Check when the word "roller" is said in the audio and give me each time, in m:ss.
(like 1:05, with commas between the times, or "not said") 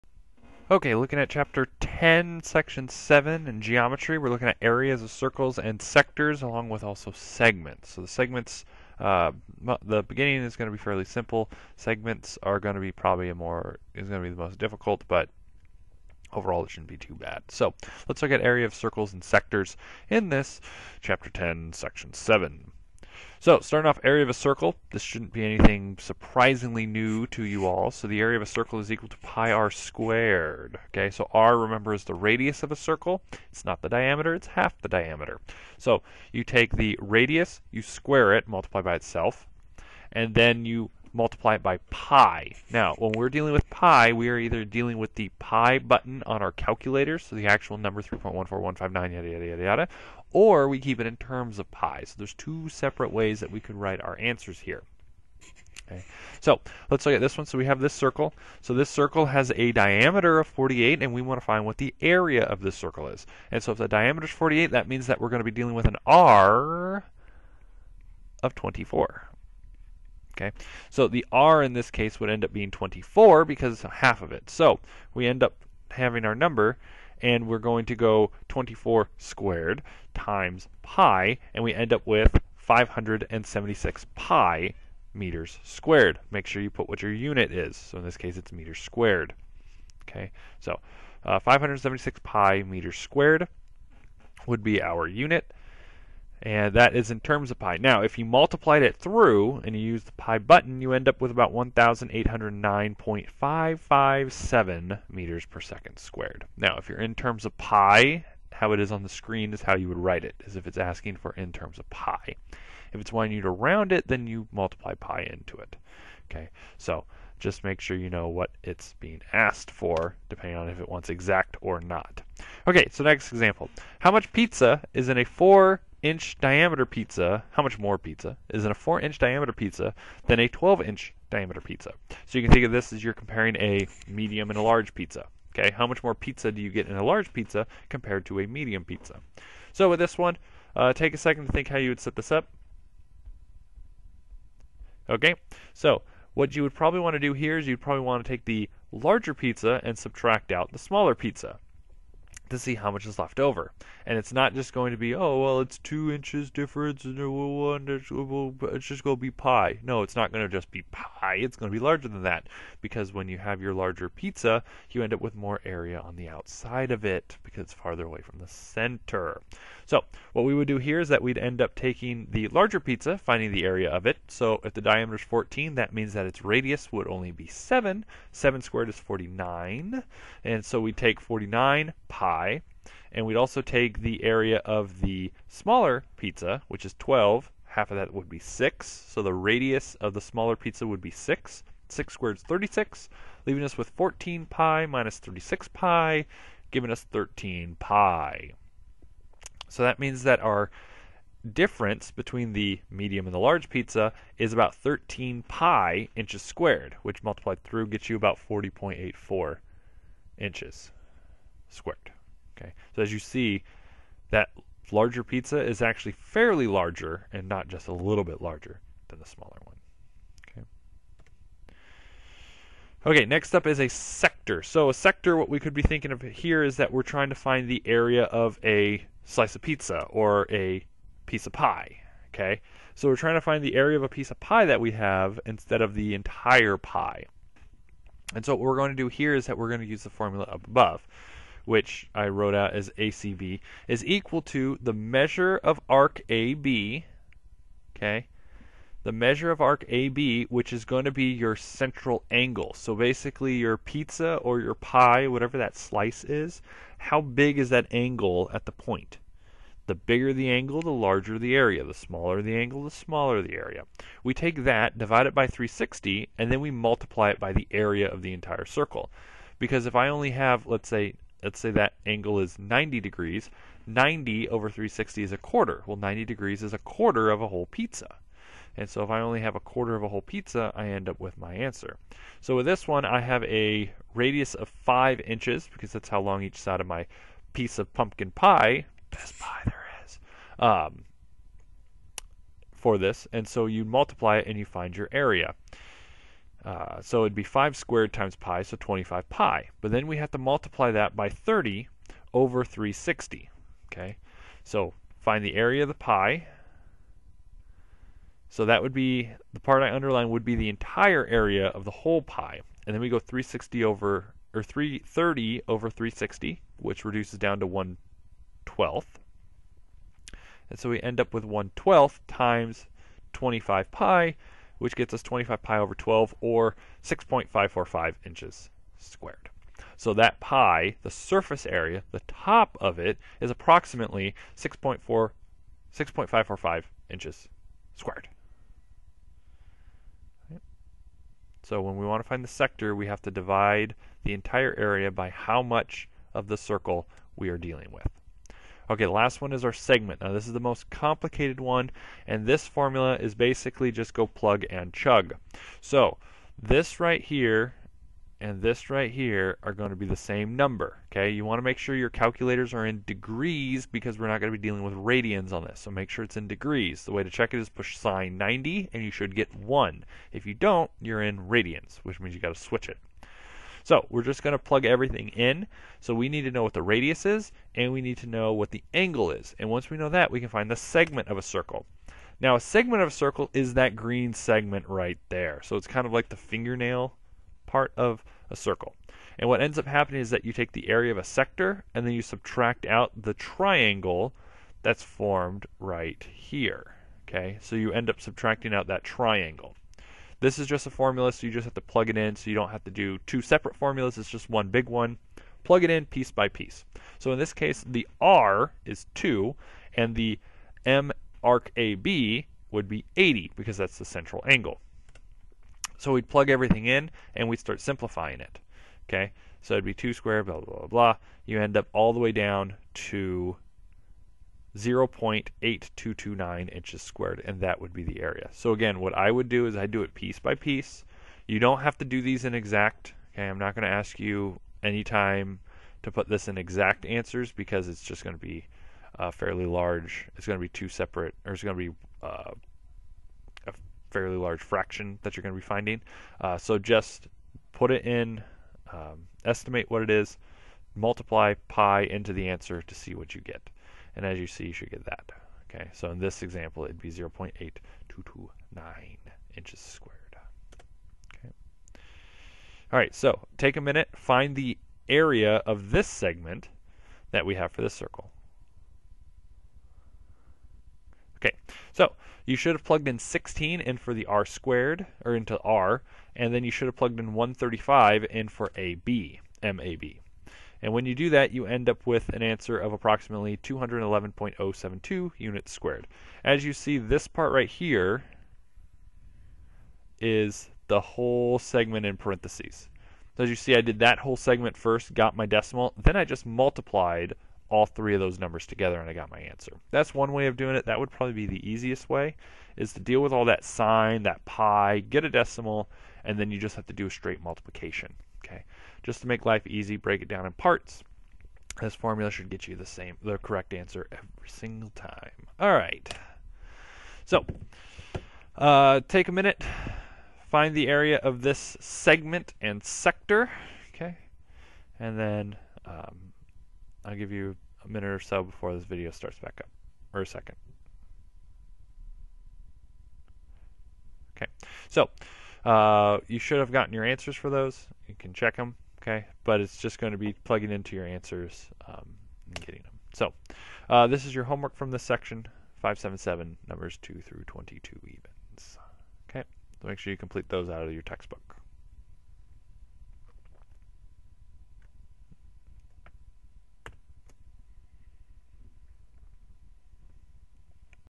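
not said.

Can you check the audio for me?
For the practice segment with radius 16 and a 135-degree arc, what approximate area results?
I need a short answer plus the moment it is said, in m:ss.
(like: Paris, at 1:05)
211.072 units squared, at 8:03.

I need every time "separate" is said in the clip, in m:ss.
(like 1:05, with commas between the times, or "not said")
0:52, 6:43, 7:20.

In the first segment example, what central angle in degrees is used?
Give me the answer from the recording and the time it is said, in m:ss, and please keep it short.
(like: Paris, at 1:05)
80, at 6:53.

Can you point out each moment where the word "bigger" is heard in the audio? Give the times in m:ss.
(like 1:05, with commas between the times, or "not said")
4:19.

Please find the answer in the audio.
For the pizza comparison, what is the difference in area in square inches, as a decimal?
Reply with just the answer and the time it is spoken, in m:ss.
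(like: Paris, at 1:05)
40.84, at 3:28.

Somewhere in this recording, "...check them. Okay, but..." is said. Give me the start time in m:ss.
8:58.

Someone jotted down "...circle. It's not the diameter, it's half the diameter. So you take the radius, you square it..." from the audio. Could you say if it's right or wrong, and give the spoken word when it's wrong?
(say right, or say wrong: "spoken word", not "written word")
right.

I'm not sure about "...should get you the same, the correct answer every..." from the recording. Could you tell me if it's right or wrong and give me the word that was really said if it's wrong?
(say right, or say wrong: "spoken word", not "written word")
right.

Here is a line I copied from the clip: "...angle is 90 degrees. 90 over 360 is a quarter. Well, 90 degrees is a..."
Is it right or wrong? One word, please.
right.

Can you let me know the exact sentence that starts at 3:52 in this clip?
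Okay, so we're trying to find the area of a piece of pie that we have instead of the entire pie.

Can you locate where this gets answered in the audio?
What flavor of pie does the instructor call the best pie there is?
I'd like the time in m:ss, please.
4:47.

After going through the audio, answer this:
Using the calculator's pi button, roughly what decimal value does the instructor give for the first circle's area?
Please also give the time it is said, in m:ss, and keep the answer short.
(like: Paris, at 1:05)
1,809.557, at 1:41.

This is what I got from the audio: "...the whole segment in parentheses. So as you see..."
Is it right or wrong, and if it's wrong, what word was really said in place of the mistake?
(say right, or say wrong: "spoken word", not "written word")
right.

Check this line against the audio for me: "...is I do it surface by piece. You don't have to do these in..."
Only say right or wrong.
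wrong.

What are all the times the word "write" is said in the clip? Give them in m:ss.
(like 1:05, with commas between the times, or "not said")
0:53, 1:49.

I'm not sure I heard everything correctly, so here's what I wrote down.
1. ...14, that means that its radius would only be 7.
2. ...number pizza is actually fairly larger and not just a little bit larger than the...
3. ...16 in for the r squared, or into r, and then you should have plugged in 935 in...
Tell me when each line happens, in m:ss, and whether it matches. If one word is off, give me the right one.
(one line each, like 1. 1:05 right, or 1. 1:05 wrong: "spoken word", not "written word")
1. 2:55 right
2. 3:34 wrong: "larger", not "number"
3. 7:53 wrong: "135", not "935".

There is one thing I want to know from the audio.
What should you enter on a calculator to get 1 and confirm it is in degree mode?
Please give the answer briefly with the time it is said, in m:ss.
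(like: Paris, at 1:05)
sine 90, at 6:07.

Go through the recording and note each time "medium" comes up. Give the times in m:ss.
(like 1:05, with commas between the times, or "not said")
2:14, 2:18, 3:22.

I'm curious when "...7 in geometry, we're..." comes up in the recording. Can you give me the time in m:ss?
0:02.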